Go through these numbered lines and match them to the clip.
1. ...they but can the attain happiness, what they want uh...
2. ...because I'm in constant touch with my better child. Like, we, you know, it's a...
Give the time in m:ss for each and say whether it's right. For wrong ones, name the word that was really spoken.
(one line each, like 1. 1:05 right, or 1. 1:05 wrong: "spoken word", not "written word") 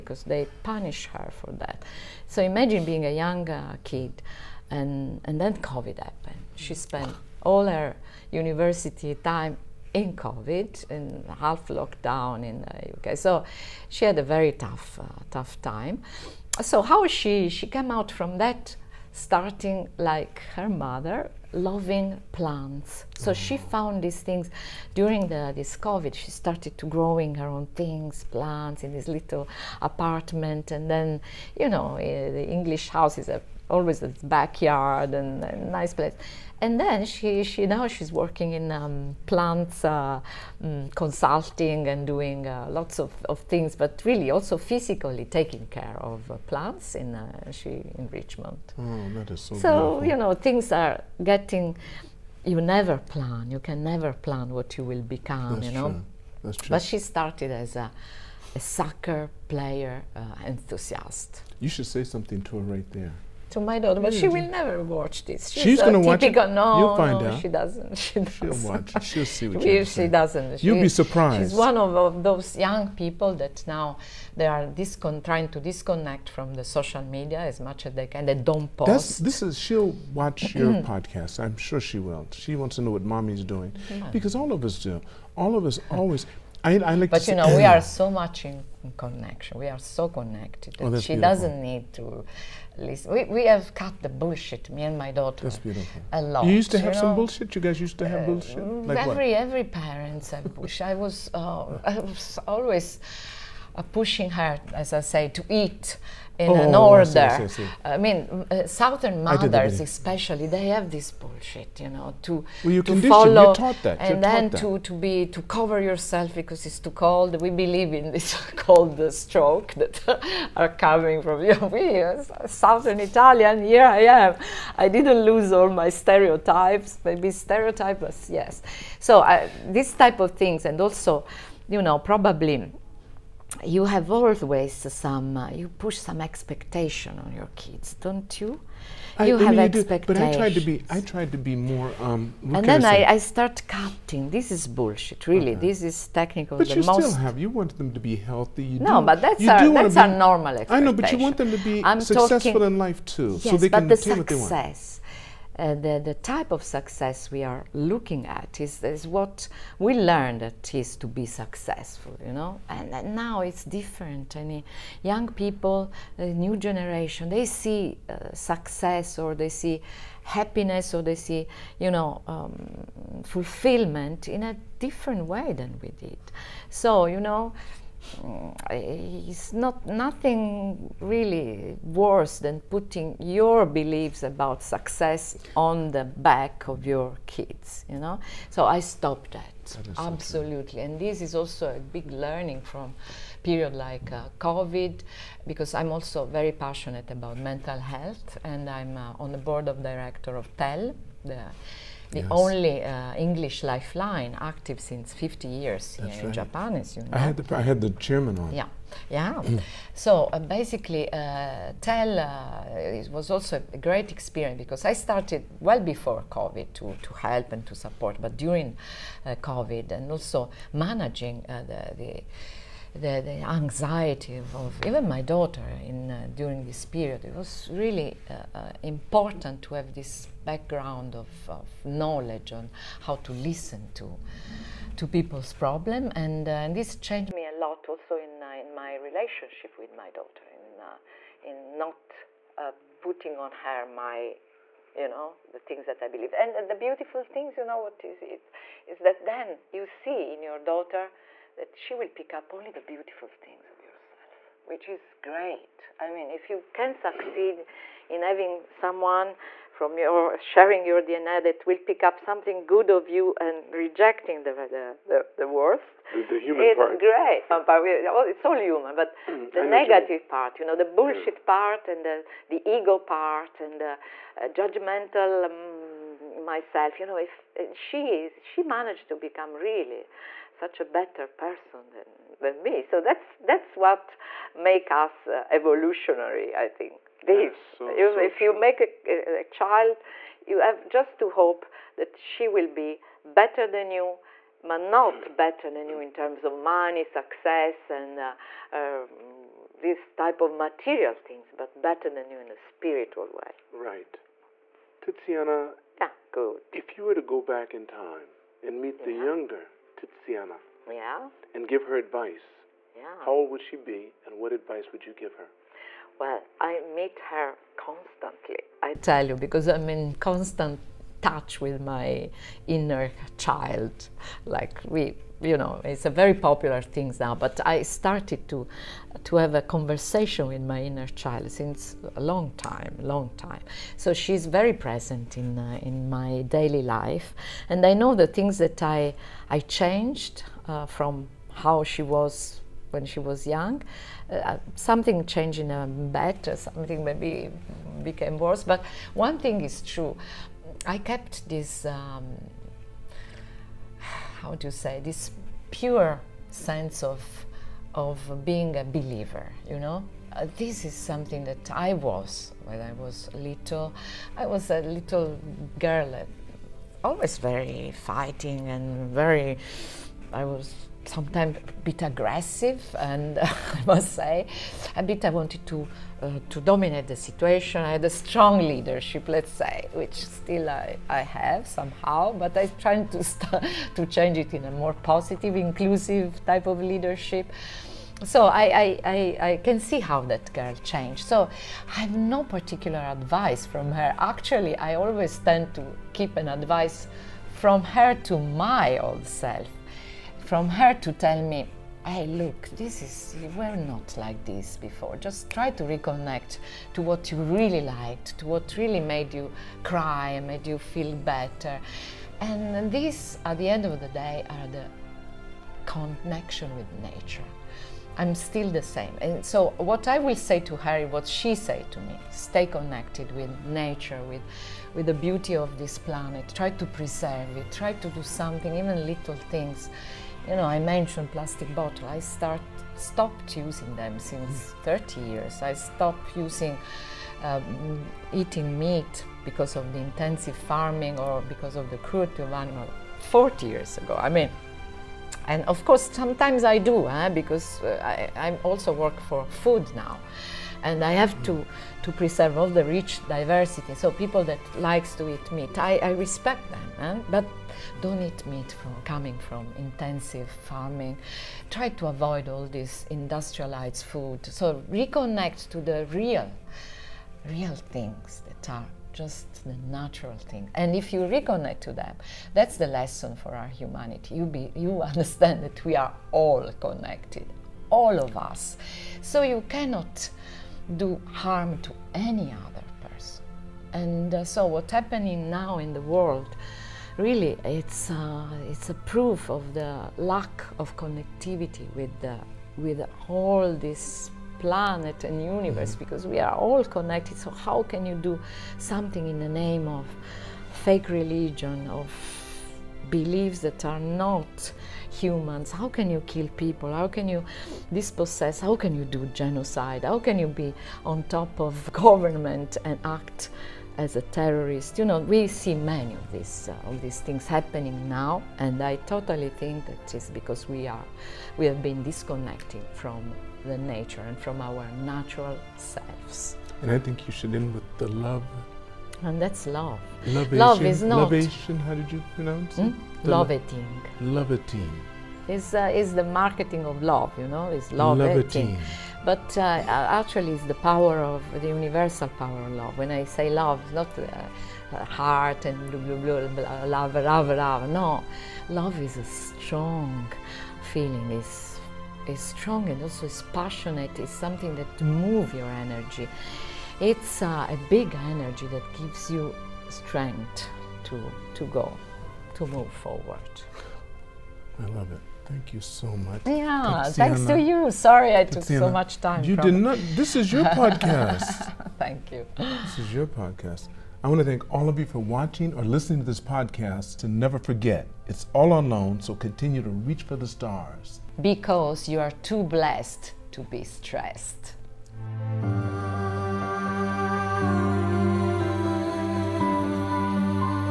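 1. 2:33 wrong: "success", not "happiness"
2. 5:19 wrong: "inner", not "better".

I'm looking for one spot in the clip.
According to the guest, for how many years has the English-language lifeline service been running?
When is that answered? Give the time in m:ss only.
3:25.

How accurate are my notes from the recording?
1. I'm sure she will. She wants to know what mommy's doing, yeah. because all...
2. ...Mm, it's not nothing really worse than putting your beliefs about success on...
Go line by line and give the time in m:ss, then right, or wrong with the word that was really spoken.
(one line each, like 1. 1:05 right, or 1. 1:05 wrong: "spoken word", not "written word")
1. 1:21 right
2. 2:58 right.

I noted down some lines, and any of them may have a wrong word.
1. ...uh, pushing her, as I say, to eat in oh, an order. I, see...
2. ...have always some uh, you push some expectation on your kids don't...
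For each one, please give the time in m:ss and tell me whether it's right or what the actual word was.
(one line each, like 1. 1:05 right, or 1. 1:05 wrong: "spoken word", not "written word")
1. 1:43 right
2. 2:13 right.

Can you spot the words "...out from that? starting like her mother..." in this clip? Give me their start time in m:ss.
0:17.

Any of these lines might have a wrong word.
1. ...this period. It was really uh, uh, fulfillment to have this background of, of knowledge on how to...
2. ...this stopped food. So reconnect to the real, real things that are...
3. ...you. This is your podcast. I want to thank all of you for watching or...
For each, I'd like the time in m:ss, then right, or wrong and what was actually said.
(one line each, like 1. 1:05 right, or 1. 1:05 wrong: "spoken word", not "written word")
1. 3:46 wrong: "important", not "fulfillment"
2. 7:42 wrong: "industrialized", not "stopped"
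3. 9:32 right.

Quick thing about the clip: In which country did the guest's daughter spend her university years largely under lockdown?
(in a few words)
UK.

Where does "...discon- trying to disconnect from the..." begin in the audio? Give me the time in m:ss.
1:14.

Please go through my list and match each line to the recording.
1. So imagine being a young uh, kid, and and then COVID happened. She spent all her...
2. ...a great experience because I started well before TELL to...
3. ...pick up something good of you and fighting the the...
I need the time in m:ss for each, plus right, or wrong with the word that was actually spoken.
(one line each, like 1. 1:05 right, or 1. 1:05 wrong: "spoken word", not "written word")
1. 0:02 right
2. 3:33 wrong: "COVID", not "TELL"
3. 4:21 wrong: "rejecting", not "fighting".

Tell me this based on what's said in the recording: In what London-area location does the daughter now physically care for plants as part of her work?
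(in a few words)
Richmond.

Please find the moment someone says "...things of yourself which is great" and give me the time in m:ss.
4:13.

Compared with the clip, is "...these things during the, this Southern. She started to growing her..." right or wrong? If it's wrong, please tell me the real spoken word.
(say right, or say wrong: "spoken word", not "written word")
wrong: "COVID", not "Southern".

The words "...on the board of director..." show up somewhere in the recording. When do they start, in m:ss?
3:19.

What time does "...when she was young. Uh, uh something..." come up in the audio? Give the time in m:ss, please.
5:42.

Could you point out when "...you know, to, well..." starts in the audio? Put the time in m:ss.
1:51.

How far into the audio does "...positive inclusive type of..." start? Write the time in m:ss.
6:24.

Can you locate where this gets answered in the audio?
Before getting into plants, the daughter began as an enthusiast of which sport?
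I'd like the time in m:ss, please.
0:58.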